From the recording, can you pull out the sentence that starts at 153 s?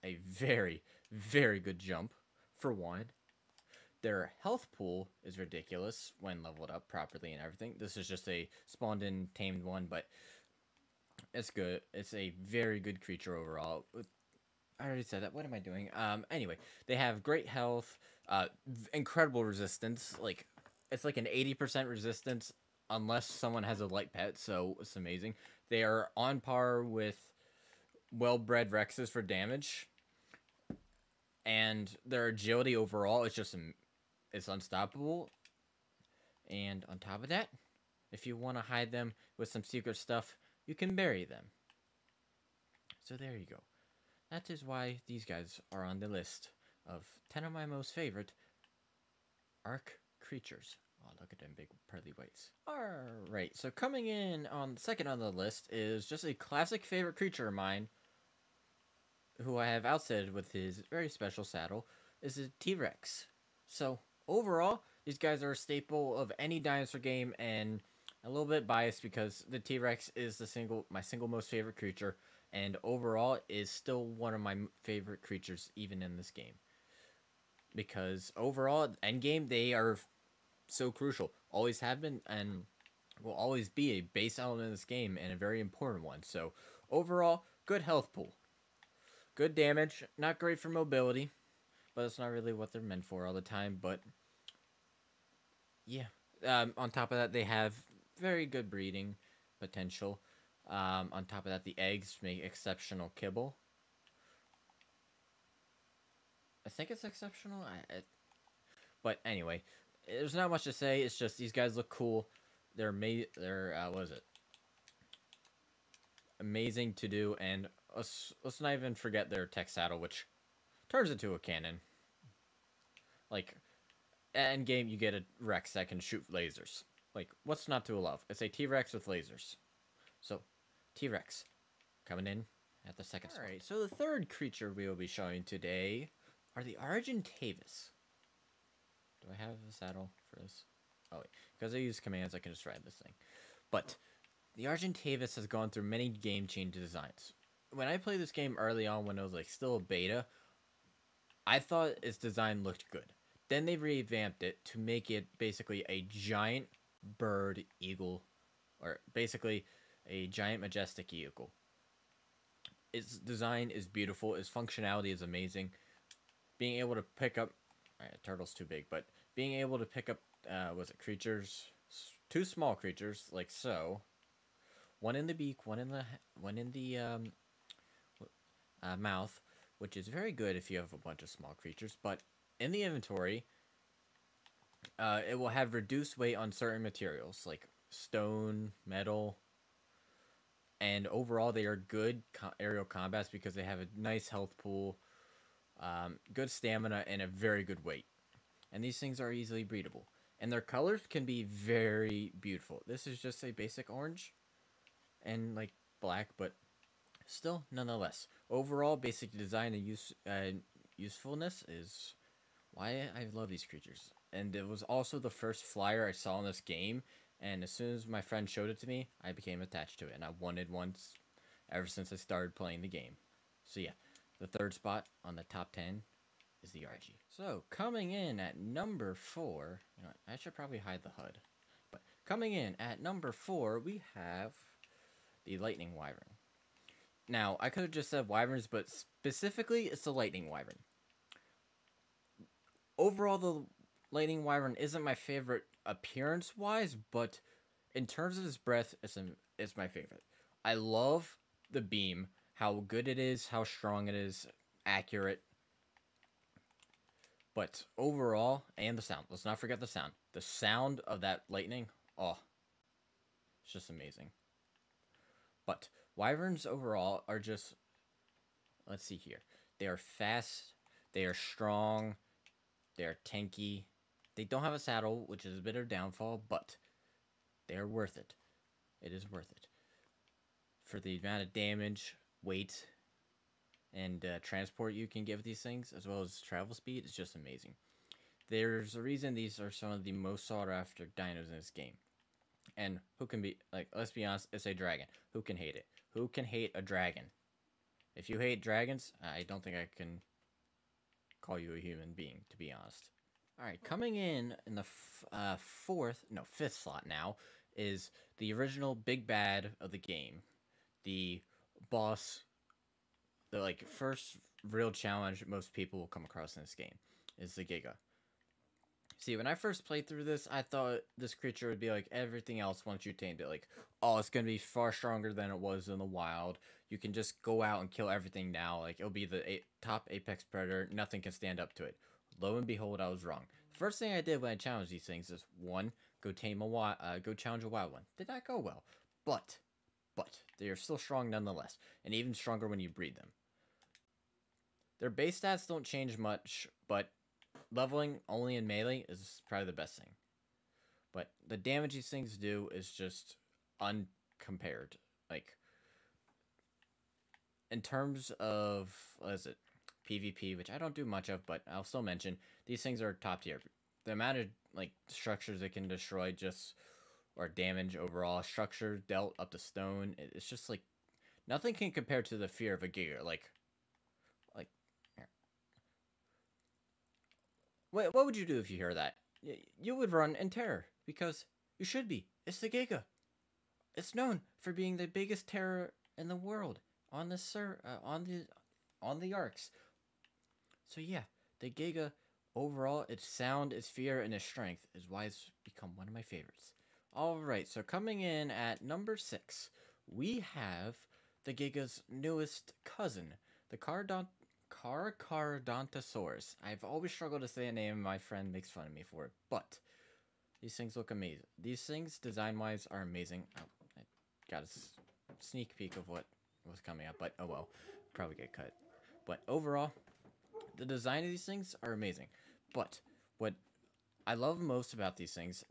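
Then they revamped it to make it basically a giant bird eagle, or basically a giant majestic vehicle.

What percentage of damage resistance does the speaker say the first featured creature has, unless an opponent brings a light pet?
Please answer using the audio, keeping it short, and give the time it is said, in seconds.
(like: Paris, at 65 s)
80%, at 21 s.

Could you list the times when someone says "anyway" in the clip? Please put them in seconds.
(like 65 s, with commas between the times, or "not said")
16 s, 109 s.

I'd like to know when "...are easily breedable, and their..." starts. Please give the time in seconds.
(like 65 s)
199 s.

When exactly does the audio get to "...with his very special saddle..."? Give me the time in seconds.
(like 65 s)
60 s.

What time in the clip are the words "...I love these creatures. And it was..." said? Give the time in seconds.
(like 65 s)
213 s.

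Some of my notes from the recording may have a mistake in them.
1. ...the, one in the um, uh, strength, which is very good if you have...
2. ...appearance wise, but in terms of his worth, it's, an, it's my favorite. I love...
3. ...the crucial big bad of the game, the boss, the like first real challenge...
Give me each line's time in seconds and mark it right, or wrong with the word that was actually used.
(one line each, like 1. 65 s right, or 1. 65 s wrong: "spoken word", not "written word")
1. 175 s wrong: "mouth", not "strength"
2. 245 s wrong: "breath", not "worth"
3. 308 s wrong: "original", not "crucial".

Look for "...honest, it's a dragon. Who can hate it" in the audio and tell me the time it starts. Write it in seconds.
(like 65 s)
294 s.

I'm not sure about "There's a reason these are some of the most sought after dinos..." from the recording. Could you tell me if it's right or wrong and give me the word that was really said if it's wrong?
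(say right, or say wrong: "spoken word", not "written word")
right.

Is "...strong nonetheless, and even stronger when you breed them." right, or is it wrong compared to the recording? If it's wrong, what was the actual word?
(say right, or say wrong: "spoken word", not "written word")
right.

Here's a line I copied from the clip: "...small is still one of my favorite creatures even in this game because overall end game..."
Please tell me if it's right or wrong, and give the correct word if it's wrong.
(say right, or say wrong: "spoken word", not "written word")
wrong: "overall", not "small".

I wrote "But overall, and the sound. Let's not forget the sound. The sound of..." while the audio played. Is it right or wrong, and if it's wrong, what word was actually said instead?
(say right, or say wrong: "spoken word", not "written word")
right.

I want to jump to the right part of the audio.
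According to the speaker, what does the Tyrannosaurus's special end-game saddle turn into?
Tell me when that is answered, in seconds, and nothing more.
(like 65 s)
121 s.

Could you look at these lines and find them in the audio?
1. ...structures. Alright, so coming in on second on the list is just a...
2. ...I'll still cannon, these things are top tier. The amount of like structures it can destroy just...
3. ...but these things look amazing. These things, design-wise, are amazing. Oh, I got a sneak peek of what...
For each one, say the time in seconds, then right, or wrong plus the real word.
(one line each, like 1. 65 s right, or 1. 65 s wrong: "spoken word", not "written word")
1. 52 s wrong: "whites", not "structures"
2. 361 s wrong: "mention", not "cannon"
3. 409 s right.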